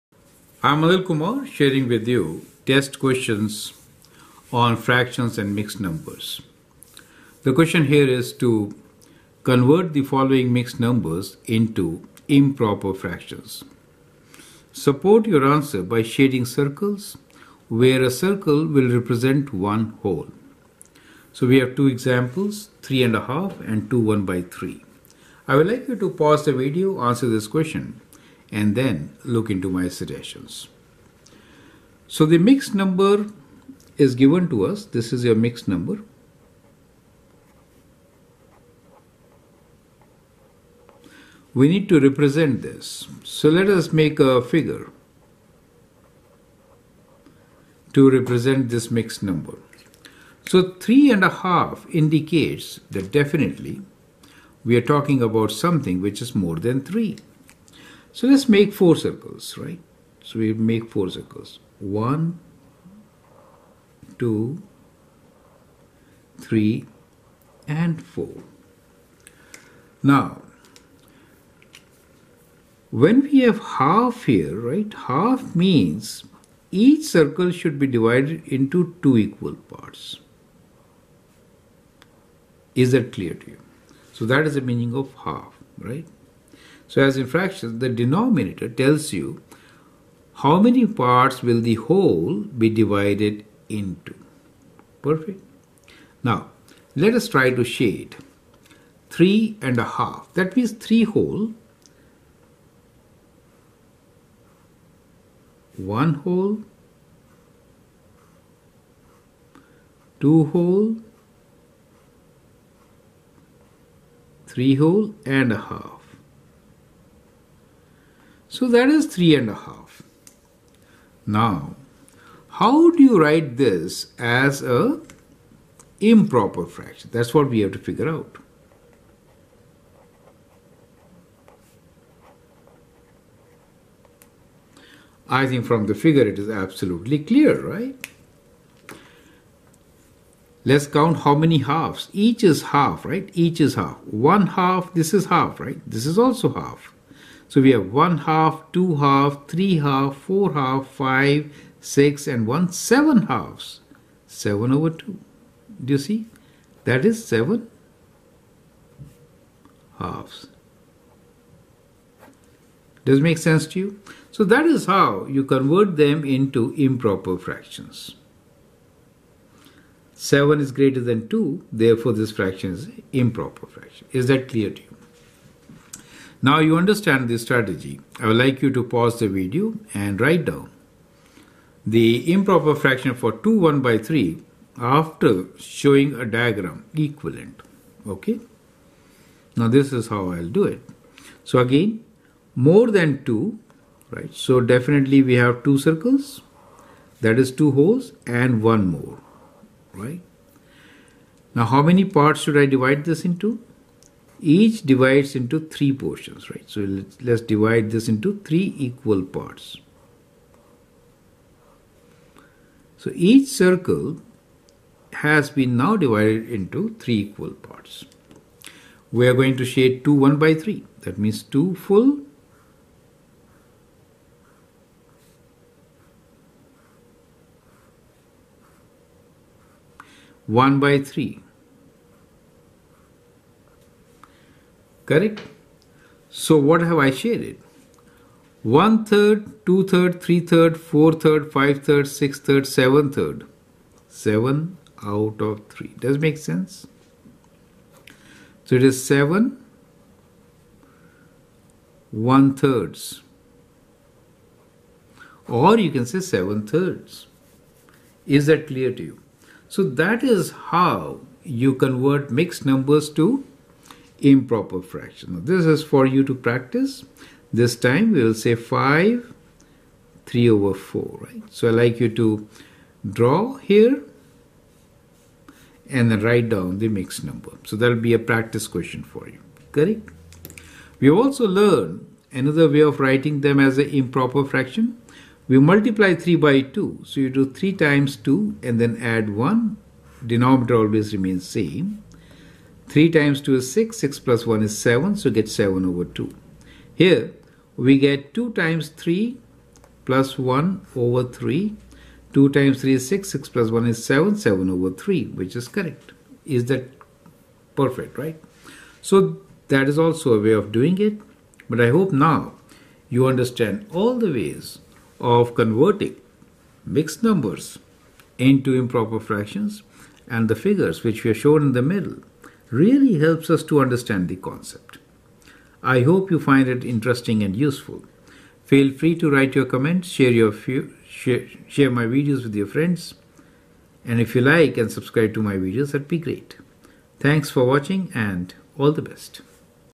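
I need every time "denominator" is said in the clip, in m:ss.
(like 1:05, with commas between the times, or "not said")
1:27, 4:50.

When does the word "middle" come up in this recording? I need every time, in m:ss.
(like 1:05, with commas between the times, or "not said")
5:21.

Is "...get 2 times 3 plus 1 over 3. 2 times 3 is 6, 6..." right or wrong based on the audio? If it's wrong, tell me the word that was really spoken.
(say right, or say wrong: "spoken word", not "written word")
right.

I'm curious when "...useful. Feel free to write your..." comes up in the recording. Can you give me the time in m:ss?
5:27.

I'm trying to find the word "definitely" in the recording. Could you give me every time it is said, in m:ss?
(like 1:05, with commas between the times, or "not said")
0:53, 3:14.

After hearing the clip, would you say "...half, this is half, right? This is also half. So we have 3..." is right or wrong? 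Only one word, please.
wrong.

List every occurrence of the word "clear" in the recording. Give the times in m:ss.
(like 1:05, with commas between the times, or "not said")
1:23, 2:17, 2:54, 4:18.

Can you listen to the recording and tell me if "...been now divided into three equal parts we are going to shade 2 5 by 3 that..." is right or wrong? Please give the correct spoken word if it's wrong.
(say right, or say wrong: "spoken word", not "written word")
wrong: "1", not "5".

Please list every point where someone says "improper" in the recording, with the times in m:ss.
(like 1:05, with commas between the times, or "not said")
0:12, 2:06, 2:46, 2:53, 3:02, 4:24, 4:43, 5:18.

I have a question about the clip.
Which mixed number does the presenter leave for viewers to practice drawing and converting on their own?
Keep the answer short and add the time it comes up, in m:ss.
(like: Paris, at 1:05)
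5 3/4, at 4:28.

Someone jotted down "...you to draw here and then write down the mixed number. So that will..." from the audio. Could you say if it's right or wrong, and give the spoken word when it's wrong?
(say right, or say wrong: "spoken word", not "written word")
right.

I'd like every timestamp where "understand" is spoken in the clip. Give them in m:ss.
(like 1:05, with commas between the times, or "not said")
2:56, 5:13, 5:23.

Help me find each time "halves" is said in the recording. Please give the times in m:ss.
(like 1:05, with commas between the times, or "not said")
2:21, 2:33, 2:39.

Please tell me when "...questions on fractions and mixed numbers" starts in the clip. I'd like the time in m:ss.
0:02.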